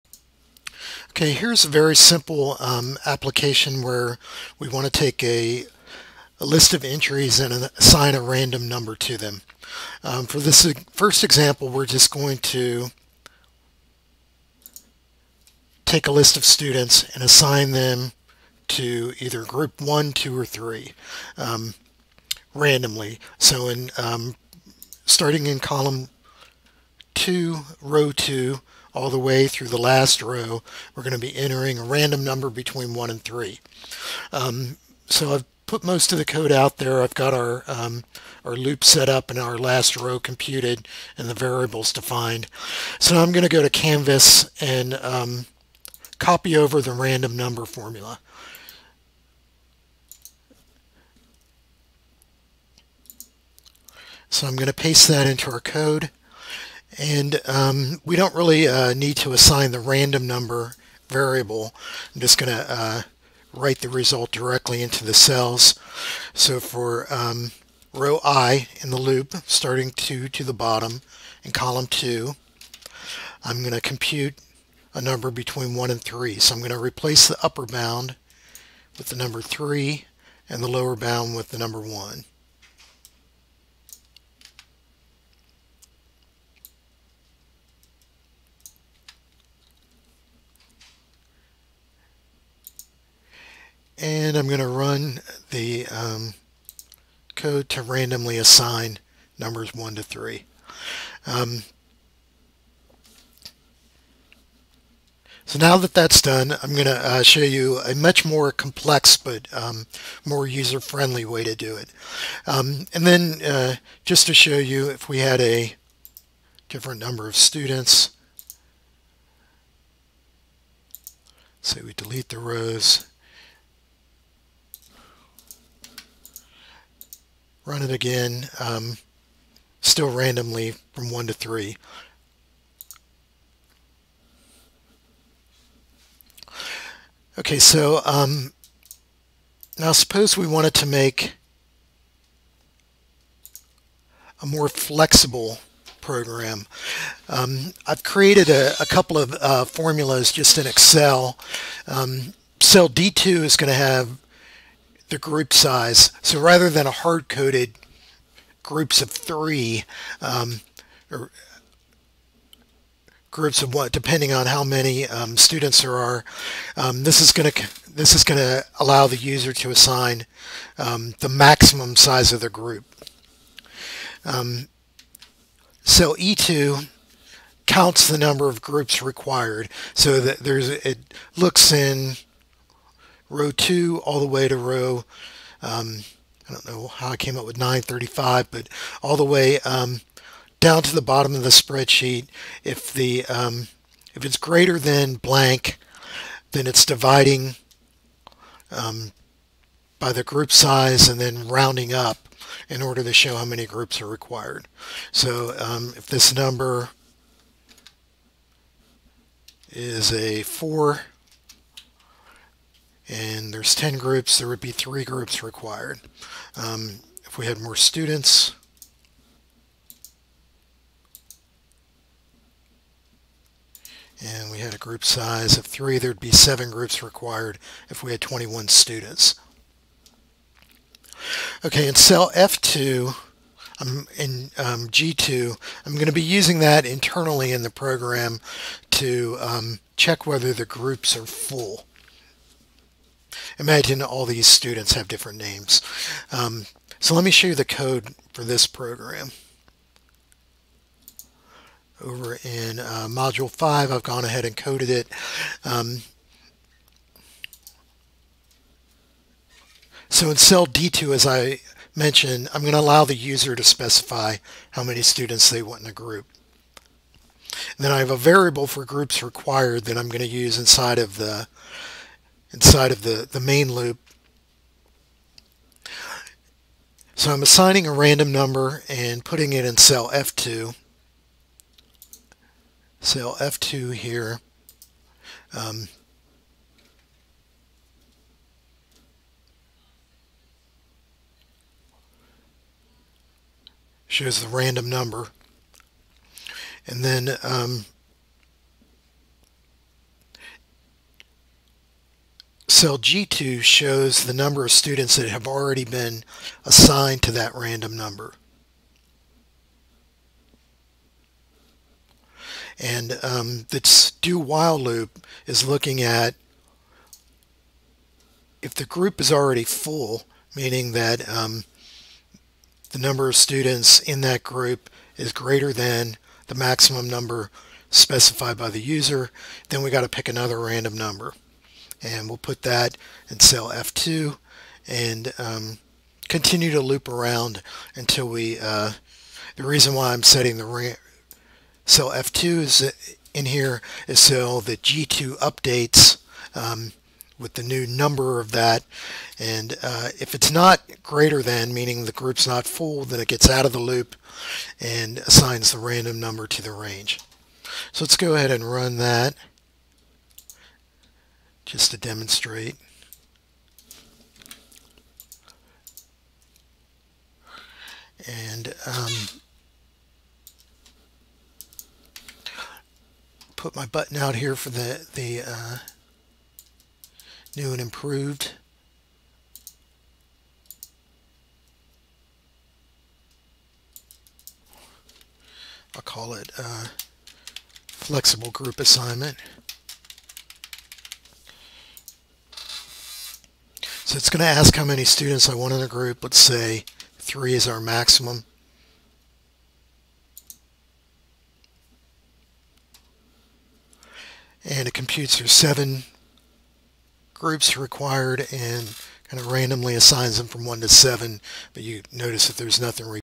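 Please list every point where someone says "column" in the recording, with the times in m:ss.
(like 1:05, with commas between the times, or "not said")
0:25, 1:11.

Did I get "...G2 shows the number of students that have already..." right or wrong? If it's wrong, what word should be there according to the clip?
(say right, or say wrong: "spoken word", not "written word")
right.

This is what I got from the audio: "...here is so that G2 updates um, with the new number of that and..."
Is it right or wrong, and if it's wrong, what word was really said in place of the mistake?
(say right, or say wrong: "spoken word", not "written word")
right.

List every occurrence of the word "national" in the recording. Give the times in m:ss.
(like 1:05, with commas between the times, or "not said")
not said.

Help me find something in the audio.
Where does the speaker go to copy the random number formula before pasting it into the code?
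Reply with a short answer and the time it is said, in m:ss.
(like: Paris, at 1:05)
Canvas, at 0:43.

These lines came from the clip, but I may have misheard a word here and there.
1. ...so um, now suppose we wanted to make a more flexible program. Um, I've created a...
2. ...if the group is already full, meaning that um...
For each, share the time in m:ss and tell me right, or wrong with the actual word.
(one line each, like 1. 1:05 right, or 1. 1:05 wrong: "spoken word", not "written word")
1. 2:17 right
2. 5:18 right.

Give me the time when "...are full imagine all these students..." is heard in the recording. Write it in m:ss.
4:01.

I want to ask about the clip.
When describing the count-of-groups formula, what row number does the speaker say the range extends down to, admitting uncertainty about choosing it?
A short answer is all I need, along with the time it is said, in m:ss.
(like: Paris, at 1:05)
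935, at 3:07.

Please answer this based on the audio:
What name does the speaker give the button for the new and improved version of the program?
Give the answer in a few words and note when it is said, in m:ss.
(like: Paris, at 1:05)
flexible group assignment, at 6:27.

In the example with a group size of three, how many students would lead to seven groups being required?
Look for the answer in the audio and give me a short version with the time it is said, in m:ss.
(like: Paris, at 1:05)
21, at 3:48.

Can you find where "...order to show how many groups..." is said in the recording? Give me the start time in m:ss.
3:22.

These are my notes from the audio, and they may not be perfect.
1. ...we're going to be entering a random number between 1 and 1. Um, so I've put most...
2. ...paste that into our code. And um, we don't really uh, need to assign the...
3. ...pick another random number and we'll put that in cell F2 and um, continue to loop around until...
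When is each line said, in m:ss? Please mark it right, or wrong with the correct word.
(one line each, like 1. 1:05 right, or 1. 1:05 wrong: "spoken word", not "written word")
1. 0:30 wrong: "3", not "1"
2. 0:54 right
3. 5:30 right.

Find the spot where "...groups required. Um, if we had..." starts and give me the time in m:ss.
3:35.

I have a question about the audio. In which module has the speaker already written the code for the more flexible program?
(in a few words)
Module 5.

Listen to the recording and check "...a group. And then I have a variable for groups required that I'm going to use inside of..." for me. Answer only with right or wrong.
right.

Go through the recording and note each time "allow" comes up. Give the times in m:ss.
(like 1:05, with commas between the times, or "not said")
2:48, 4:22.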